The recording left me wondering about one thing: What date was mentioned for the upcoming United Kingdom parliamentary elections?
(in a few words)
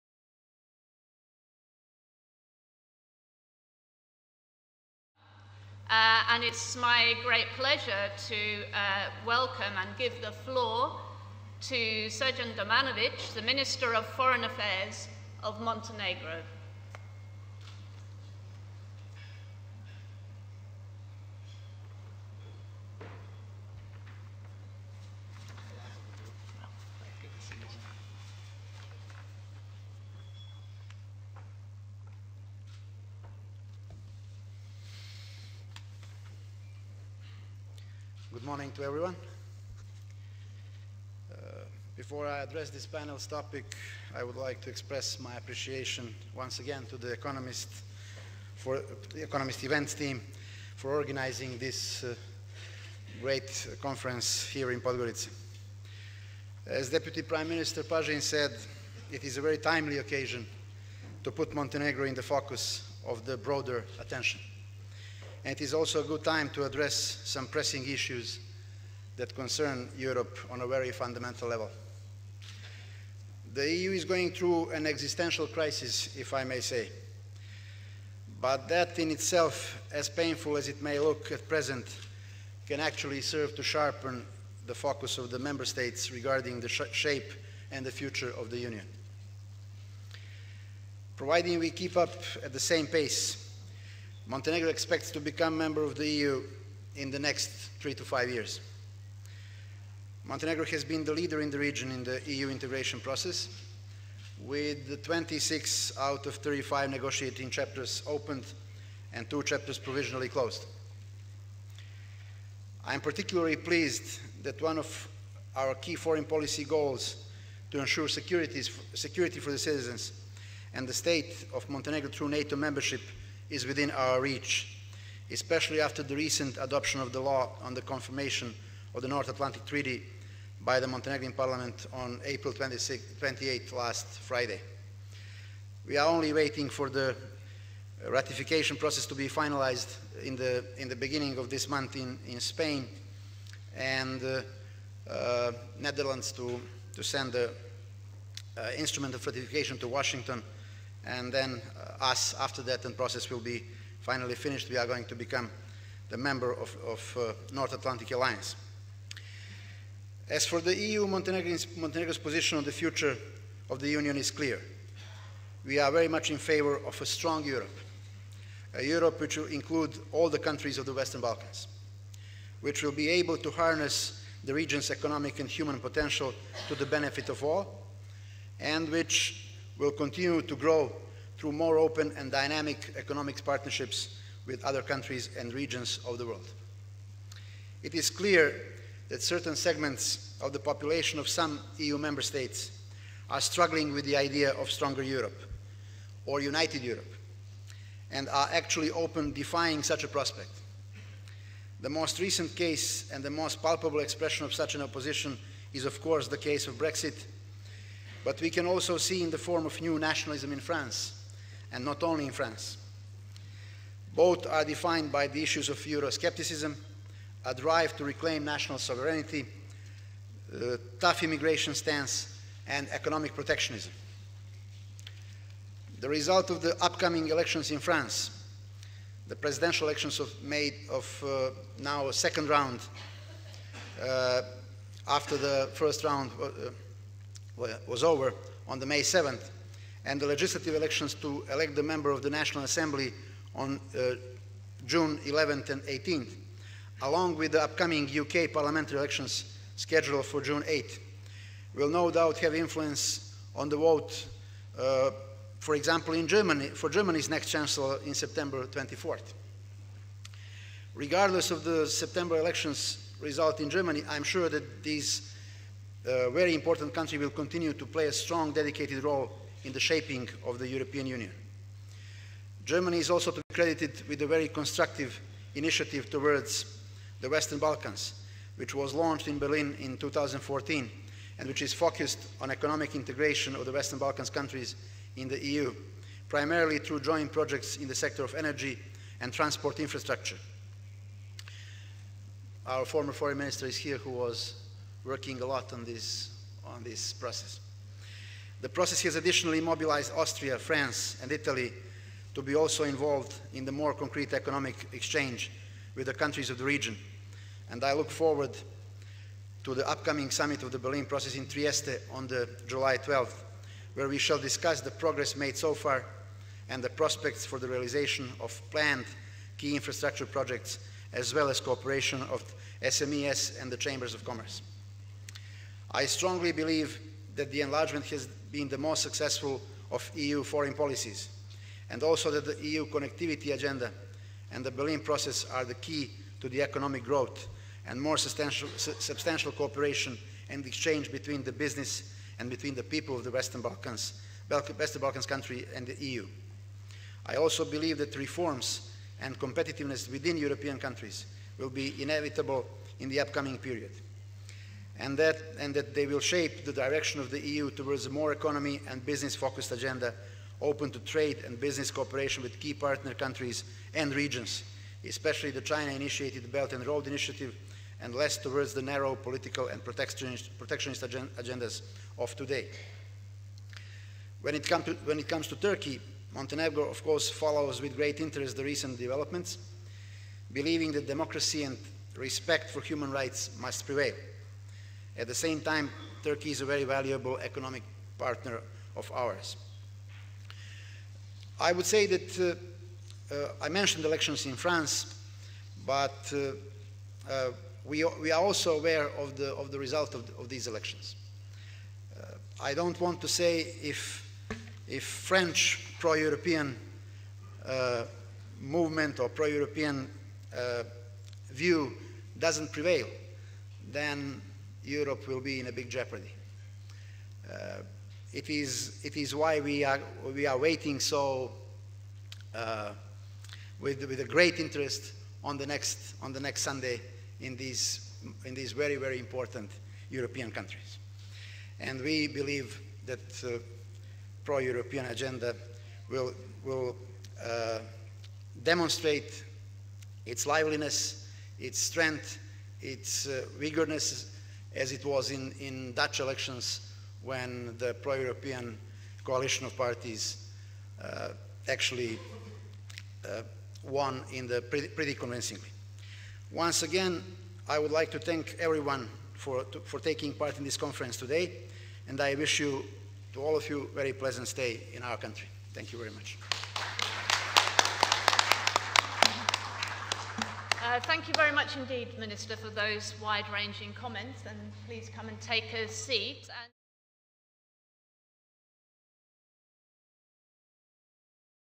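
June 8th.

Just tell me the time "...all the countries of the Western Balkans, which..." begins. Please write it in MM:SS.
02:50.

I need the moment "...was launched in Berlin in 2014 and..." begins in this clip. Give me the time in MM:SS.
04:38.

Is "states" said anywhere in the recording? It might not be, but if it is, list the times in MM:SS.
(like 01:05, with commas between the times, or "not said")
01:25, 02:00, 03:12.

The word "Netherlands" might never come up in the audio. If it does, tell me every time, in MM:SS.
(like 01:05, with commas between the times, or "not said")
02:25.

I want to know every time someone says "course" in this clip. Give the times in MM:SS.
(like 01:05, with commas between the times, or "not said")
03:26, 06:17.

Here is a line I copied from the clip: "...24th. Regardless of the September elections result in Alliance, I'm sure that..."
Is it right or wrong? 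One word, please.
wrong.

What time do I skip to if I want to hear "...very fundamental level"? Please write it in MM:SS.
01:10.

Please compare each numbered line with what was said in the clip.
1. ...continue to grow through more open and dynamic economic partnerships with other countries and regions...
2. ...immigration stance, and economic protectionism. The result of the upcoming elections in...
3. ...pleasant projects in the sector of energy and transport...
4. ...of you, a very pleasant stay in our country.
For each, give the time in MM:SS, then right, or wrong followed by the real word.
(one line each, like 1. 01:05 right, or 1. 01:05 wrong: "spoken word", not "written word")
1. 02:59 right
2. 03:41 right
3. 04:46 wrong: "joint", not "pleasant"
4. 07:43 right.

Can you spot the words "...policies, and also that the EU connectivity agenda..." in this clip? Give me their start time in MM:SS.
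05:30.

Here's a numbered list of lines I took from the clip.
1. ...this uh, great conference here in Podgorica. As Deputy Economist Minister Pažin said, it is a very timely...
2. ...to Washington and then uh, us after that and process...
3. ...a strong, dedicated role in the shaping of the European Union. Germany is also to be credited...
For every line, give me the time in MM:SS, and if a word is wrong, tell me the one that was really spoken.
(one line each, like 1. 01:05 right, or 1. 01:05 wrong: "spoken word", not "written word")
1. 00:51 wrong: "Prime", not "Economist"
2. 02:29 right
3. 04:28 right.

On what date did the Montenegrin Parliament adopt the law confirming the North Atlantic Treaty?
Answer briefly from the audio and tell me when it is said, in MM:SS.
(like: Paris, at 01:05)
April 28th, at 02:12.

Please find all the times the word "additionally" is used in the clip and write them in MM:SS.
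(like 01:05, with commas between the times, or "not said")
04:59.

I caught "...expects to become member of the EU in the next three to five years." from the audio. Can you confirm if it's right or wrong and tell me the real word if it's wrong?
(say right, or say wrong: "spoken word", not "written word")
right.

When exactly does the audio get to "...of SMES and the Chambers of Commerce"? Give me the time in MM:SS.
05:22.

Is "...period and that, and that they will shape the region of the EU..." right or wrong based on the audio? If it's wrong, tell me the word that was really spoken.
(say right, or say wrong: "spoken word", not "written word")
wrong: "direction", not "region".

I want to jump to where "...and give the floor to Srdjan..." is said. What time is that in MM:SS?
00:09.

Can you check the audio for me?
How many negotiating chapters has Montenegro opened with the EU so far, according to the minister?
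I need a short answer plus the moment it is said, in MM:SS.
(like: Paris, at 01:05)
26, at 01:45.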